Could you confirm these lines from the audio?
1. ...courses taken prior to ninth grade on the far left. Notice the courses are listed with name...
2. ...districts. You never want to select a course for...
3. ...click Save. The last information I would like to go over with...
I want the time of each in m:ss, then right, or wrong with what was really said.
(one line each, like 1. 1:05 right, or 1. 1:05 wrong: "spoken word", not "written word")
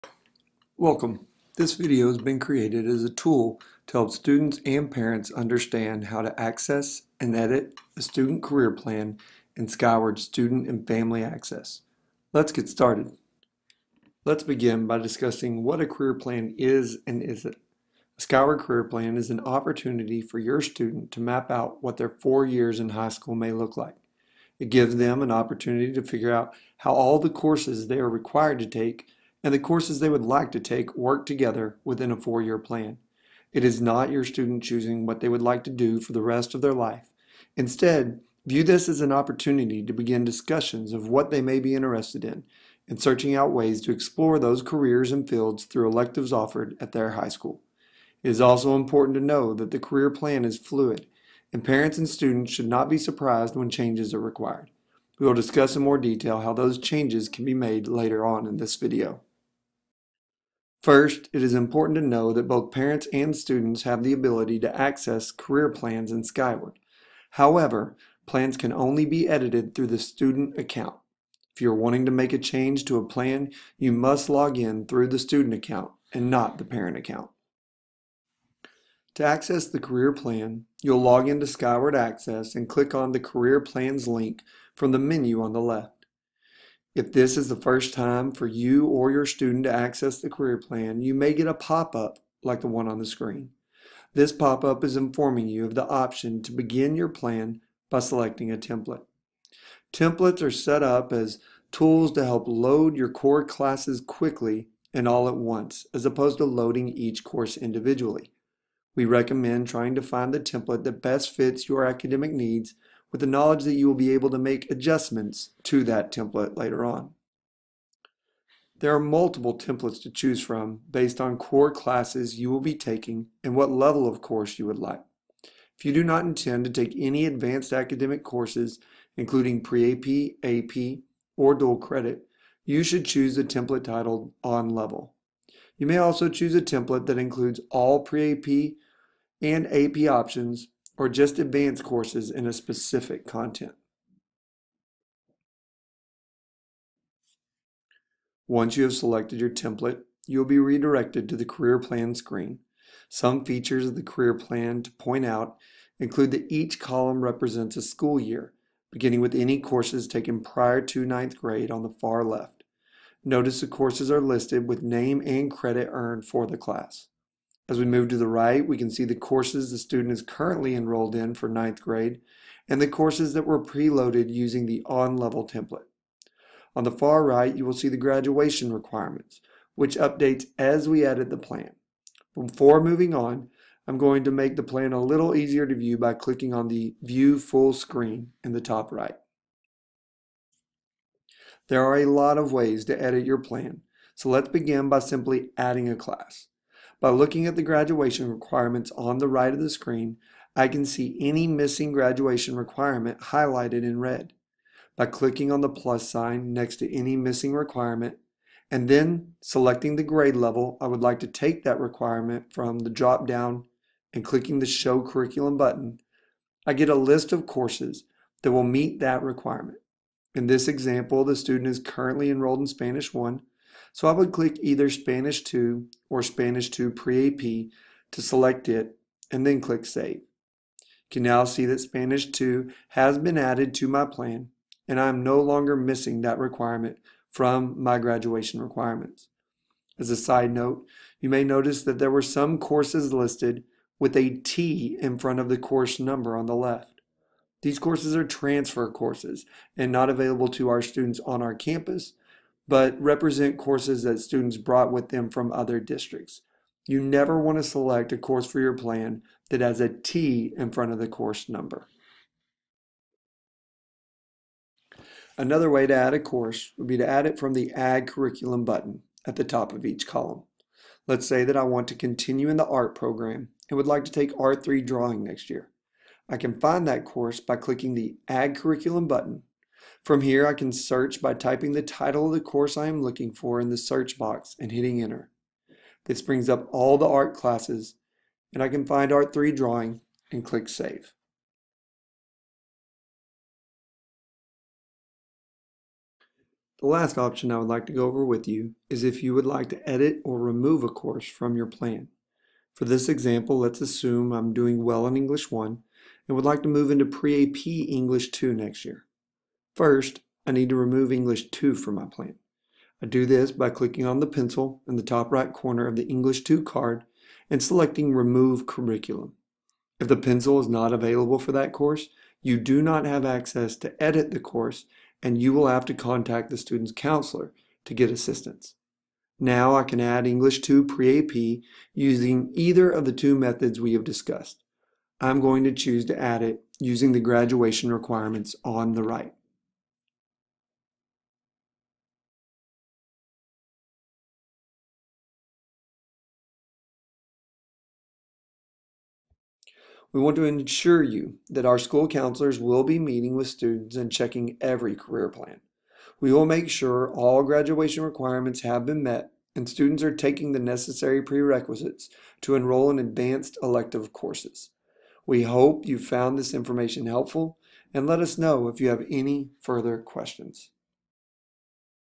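1. 2:39 right
2. 4:15 right
3. 4:50 wrong: "option", not "information".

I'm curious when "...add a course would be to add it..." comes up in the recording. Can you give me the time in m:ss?
4:25.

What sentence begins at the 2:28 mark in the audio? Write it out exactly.
Once you have selected your template, you'll be redirected to the career plan screen.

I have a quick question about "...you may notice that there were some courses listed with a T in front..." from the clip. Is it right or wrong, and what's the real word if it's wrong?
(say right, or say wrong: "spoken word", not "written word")
right.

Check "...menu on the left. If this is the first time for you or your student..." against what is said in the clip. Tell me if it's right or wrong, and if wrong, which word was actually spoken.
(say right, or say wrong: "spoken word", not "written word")
right.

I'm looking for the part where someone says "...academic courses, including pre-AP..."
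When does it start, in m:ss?
2:07.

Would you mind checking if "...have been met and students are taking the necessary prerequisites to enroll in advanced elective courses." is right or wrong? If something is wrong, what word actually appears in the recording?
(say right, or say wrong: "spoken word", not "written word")
right.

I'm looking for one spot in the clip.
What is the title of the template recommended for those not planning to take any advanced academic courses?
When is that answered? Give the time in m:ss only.
2:14.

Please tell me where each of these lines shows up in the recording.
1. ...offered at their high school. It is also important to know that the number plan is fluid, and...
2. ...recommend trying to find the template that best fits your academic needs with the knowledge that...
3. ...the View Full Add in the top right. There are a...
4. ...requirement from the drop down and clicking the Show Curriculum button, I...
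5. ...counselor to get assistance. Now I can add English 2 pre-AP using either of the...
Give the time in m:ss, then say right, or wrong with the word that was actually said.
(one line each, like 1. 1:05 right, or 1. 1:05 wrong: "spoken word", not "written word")
1. 0:46 wrong: "career", not "number"
2. 1:49 right
3. 3:06 wrong: "Screen", not "Add"
4. 3:31 right
5. 5:26 right.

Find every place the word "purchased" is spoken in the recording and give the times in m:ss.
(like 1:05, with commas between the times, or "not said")
not said.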